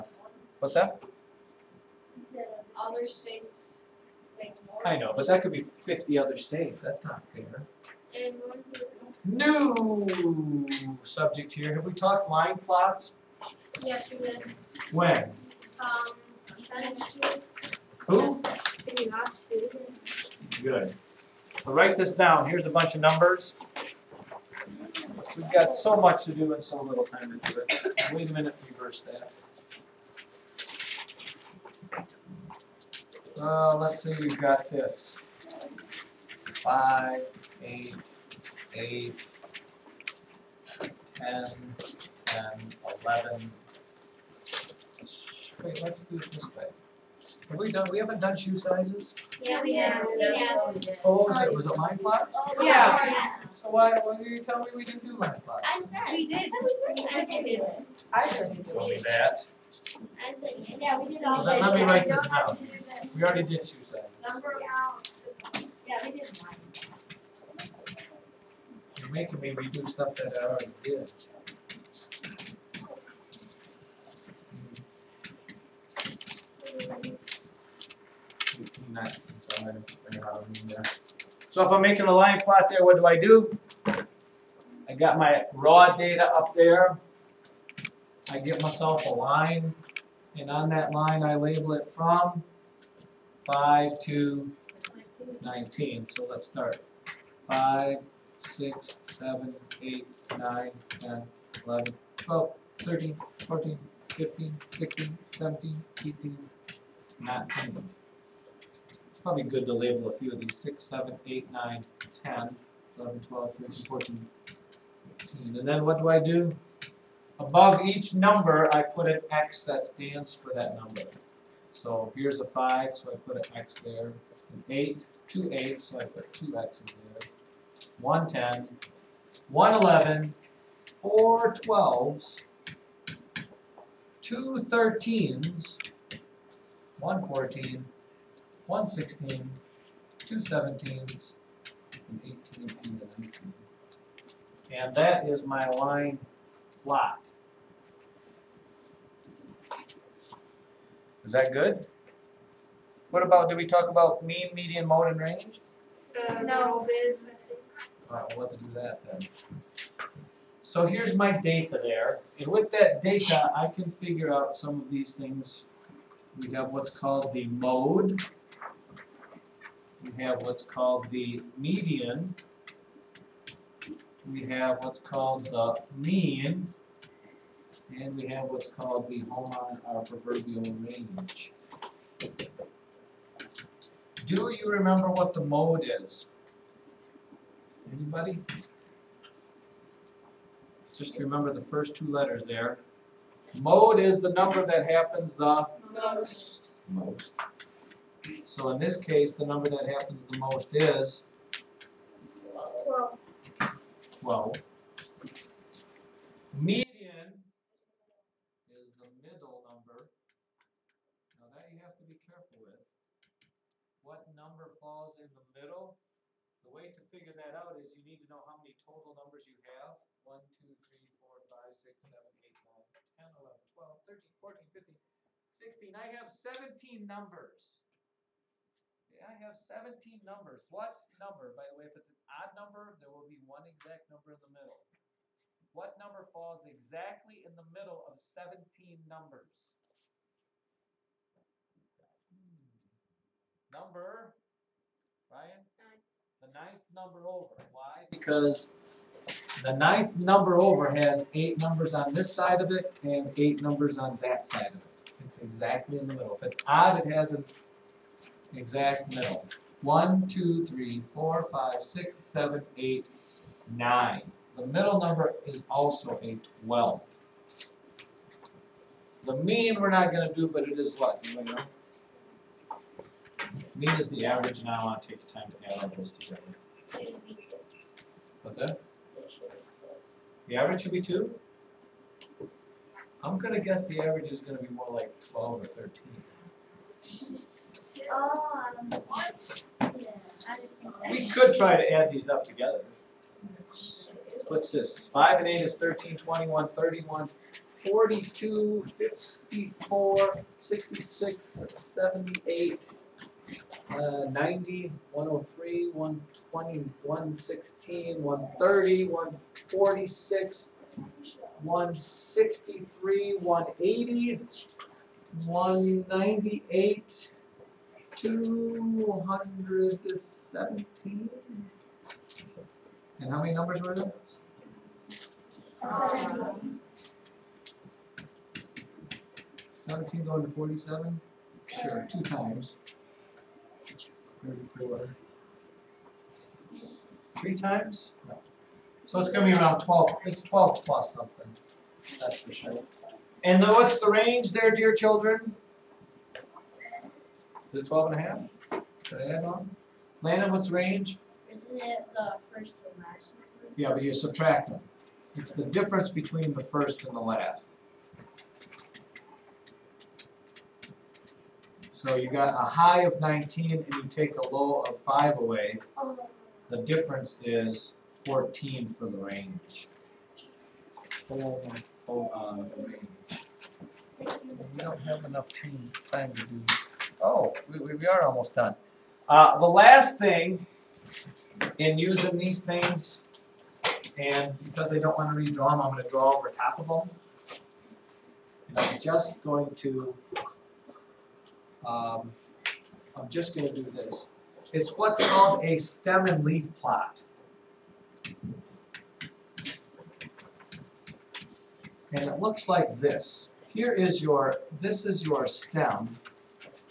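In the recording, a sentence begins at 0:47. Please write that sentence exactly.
Have we done, we haven't done shoe sizes?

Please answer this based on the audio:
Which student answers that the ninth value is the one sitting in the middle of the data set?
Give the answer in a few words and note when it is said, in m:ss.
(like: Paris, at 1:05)
Ryan, at 4:05.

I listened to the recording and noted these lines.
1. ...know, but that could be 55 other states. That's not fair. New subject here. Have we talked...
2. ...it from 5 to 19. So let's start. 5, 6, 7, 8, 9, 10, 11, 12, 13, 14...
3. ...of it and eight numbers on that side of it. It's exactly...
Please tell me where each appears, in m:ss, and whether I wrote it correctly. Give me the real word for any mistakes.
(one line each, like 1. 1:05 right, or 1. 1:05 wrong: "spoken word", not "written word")
1. 0:04 wrong: "50", not "55"
2. 1:31 right
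3. 4:12 right.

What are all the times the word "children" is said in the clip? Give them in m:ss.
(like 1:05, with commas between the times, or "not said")
5:44.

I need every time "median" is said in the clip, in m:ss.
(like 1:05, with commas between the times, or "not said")
2:34, 2:51, 3:26.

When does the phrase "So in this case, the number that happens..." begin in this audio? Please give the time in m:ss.
3:18.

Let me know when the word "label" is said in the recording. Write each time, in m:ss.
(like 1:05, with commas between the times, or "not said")
1:31, 1:49.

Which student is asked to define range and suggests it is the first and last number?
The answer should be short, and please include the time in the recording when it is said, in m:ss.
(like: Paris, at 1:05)
Landon, at 5:50.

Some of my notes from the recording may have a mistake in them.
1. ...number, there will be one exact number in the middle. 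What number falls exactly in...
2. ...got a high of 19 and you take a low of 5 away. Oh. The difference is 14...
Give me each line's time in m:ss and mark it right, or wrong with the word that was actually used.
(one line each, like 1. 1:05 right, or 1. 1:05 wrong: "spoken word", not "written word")
1. 3:52 right
2. 6:02 right.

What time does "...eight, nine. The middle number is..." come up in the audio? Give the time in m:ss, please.
4:22.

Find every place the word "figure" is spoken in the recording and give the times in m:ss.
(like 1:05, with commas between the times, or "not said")
2:43, 3:37.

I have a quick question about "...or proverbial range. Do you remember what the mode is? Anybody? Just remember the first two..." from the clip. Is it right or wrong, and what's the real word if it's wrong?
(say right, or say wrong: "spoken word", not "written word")
right.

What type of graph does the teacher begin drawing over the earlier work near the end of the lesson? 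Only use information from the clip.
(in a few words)
stem and leaf plot.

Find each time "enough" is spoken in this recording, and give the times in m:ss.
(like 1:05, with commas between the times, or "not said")
6:15.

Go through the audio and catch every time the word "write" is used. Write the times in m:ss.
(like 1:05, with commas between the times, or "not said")
0:21, 1:01.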